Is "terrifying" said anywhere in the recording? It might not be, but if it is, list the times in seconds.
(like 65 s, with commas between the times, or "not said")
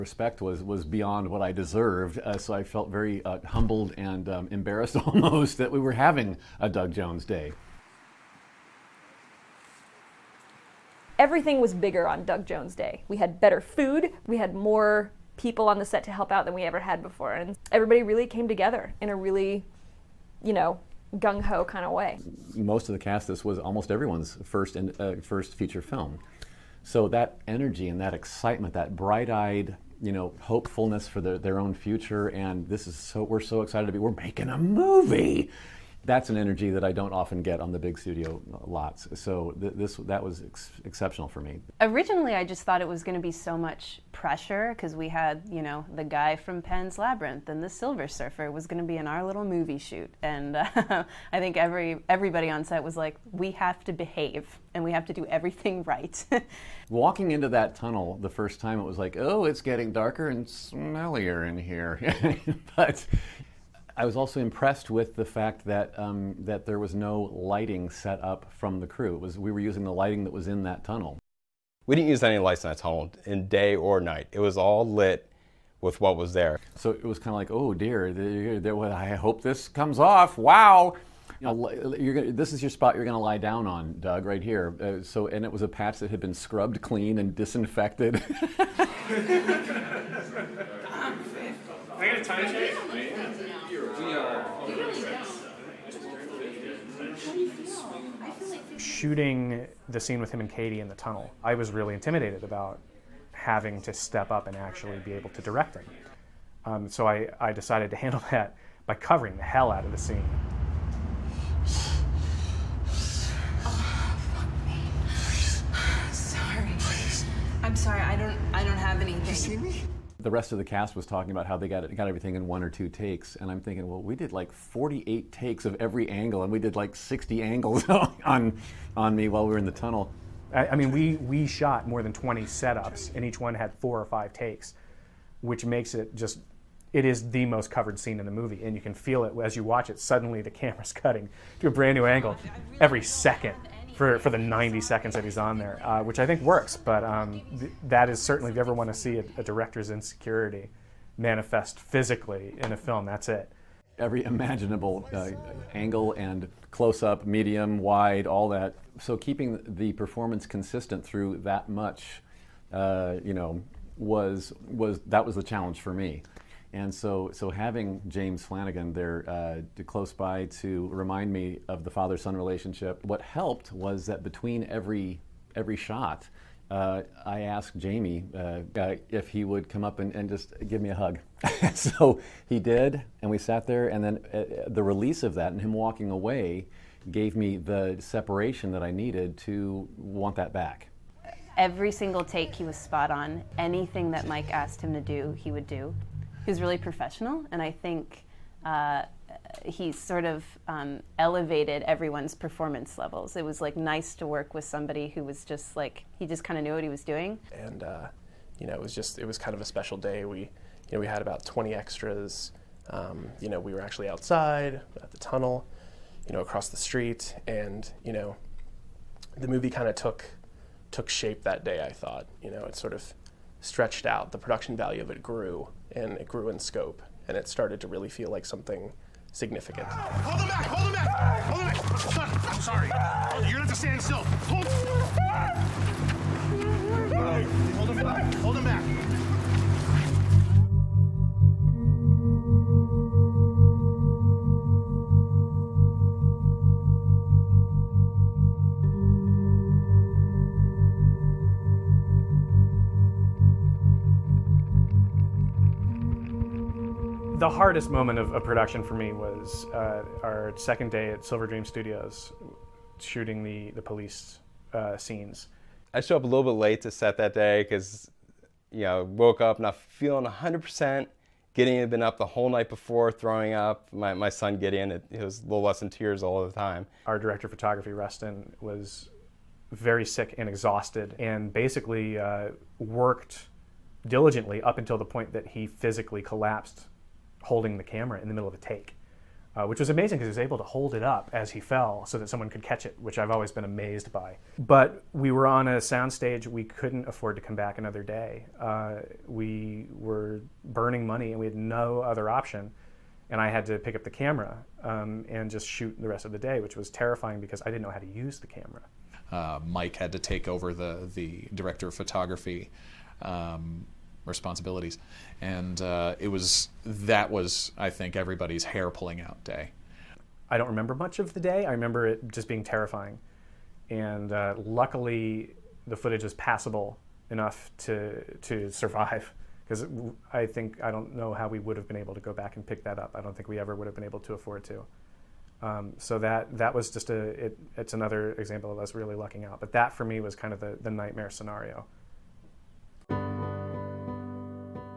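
306 s, 322 s.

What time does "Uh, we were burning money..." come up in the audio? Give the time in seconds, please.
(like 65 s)
298 s.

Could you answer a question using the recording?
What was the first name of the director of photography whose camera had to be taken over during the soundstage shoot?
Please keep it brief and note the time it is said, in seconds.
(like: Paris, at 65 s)
Rustin, at 277 s.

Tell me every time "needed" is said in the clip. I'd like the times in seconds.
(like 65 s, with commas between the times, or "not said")
188 s.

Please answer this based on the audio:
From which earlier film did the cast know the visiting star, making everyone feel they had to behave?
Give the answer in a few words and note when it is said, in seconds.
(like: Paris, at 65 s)
Pan's Labyrinth, at 46 s.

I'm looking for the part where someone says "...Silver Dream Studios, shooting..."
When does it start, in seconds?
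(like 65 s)
261 s.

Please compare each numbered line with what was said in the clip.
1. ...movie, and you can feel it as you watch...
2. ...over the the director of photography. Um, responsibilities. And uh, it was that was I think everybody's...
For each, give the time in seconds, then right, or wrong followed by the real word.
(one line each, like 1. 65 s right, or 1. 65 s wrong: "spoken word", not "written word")
1. 138 s right
2. 310 s right.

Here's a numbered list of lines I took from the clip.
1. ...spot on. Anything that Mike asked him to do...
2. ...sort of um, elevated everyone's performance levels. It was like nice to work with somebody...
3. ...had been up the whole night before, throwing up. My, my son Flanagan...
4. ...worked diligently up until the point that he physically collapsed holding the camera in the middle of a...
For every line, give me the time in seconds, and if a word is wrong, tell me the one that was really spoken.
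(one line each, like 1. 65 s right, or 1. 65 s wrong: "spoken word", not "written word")
1. 192 s right
2. 199 s right
3. 271 s wrong: "Gideon", not "Flanagan"
4. 282 s right.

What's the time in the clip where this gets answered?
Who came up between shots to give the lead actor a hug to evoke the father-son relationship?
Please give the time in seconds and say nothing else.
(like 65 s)
168 s.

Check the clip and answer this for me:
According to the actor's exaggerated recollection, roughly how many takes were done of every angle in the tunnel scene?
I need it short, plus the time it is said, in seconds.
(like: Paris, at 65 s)
48, at 124 s.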